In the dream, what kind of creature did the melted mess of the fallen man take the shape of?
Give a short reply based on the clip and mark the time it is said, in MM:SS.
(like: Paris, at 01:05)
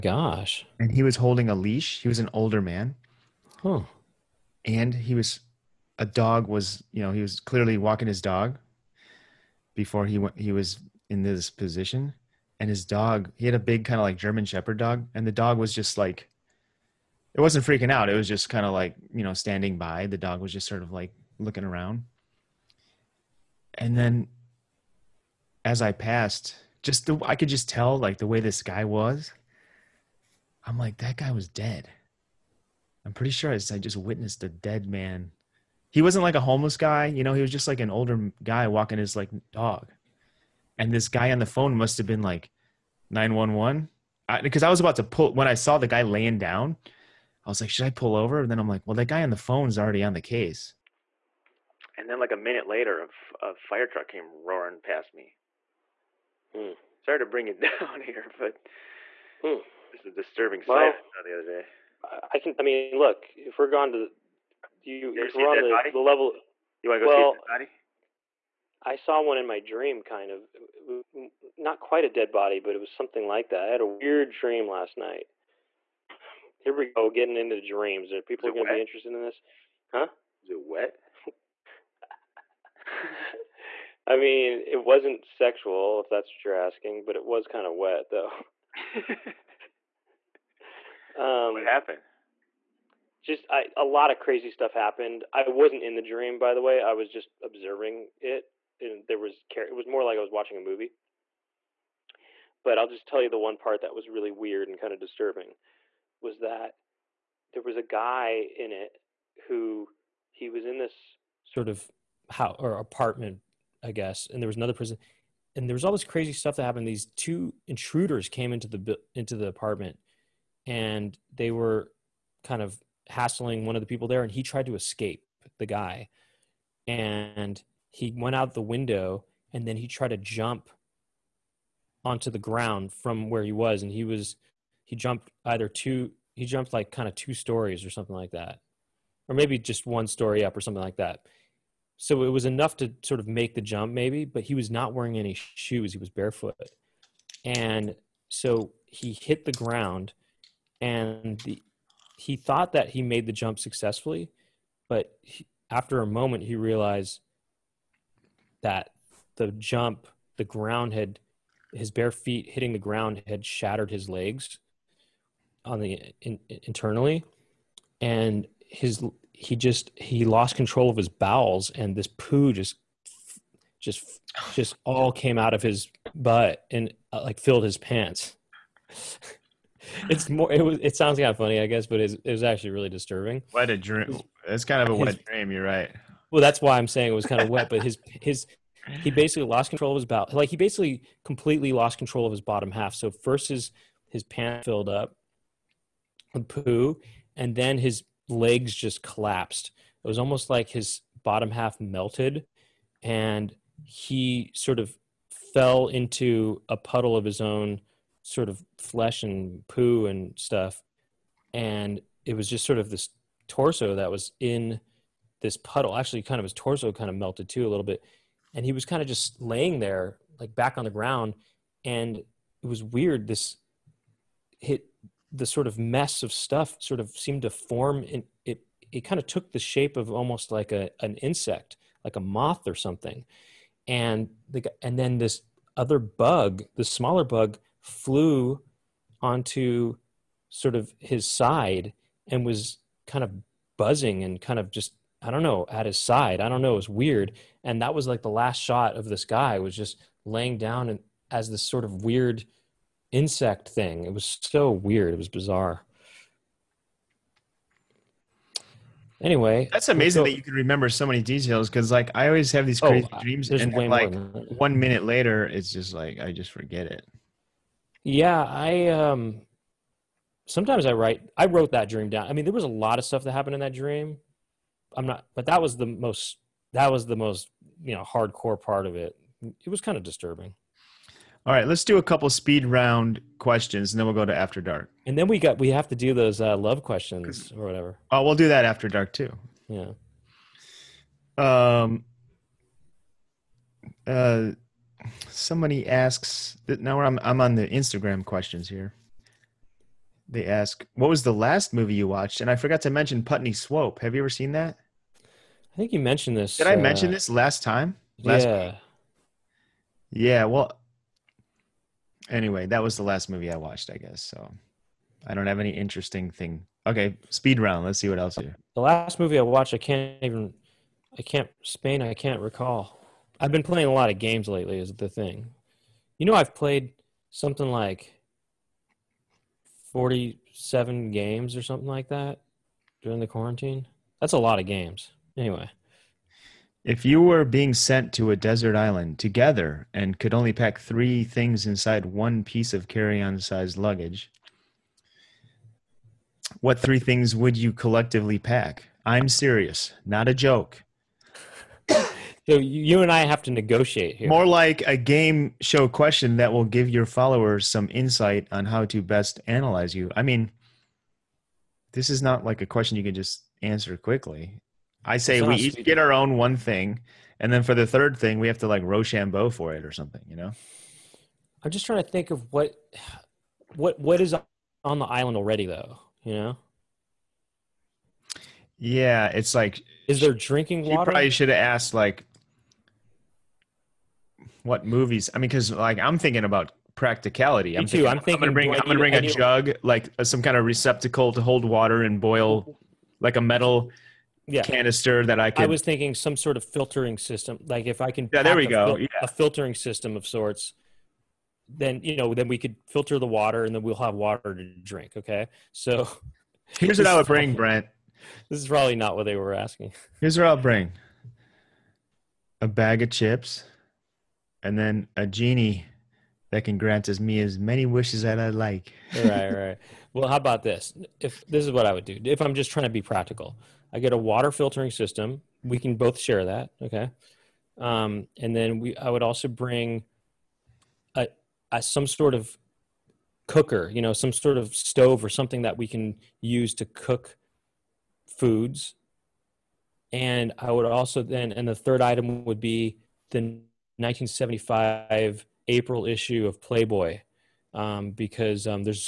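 A moth, at 03:52.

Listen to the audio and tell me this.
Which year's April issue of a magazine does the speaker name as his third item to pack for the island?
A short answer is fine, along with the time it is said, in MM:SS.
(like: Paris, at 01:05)
1975, at 07:23.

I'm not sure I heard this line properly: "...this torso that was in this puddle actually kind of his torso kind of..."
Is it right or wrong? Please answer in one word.
right.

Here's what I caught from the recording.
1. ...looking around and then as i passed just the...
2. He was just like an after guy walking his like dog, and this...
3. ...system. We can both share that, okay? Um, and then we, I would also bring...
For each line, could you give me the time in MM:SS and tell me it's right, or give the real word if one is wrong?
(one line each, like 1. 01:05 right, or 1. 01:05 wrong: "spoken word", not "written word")
1. 00:21 right
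2. 00:37 wrong: "older", not "after"
3. 07:04 right.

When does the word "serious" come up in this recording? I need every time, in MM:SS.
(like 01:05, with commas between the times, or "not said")
05:49.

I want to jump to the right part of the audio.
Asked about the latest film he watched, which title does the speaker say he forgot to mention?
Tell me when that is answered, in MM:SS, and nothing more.
05:03.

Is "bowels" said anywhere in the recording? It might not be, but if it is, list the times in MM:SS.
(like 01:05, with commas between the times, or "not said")
02:51, 03:10.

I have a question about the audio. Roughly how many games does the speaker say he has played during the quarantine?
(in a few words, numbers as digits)
47.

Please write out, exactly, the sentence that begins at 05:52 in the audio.
So you and I have to negotiate here.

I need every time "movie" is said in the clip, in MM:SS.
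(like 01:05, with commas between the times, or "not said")
01:40, 05:01, 05:13, 05:19, 06:24.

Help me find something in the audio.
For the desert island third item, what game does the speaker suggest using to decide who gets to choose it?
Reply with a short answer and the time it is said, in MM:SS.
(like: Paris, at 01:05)
Rochambeau, at 06:08.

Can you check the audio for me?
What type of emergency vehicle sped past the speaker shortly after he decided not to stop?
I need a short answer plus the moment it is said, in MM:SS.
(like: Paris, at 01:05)
Fire truck, at 00:53.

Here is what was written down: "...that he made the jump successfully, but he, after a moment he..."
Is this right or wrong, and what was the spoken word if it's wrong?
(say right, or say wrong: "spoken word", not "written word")
right.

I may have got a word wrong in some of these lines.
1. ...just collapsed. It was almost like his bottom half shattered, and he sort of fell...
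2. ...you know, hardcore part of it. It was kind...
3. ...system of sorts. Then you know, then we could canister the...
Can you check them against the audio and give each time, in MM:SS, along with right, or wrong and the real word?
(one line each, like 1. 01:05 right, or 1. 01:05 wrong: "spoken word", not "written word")
1. 03:18 wrong: "melted", not "shattered"
2. 04:37 right
3. 06:39 wrong: "filter", not "canister".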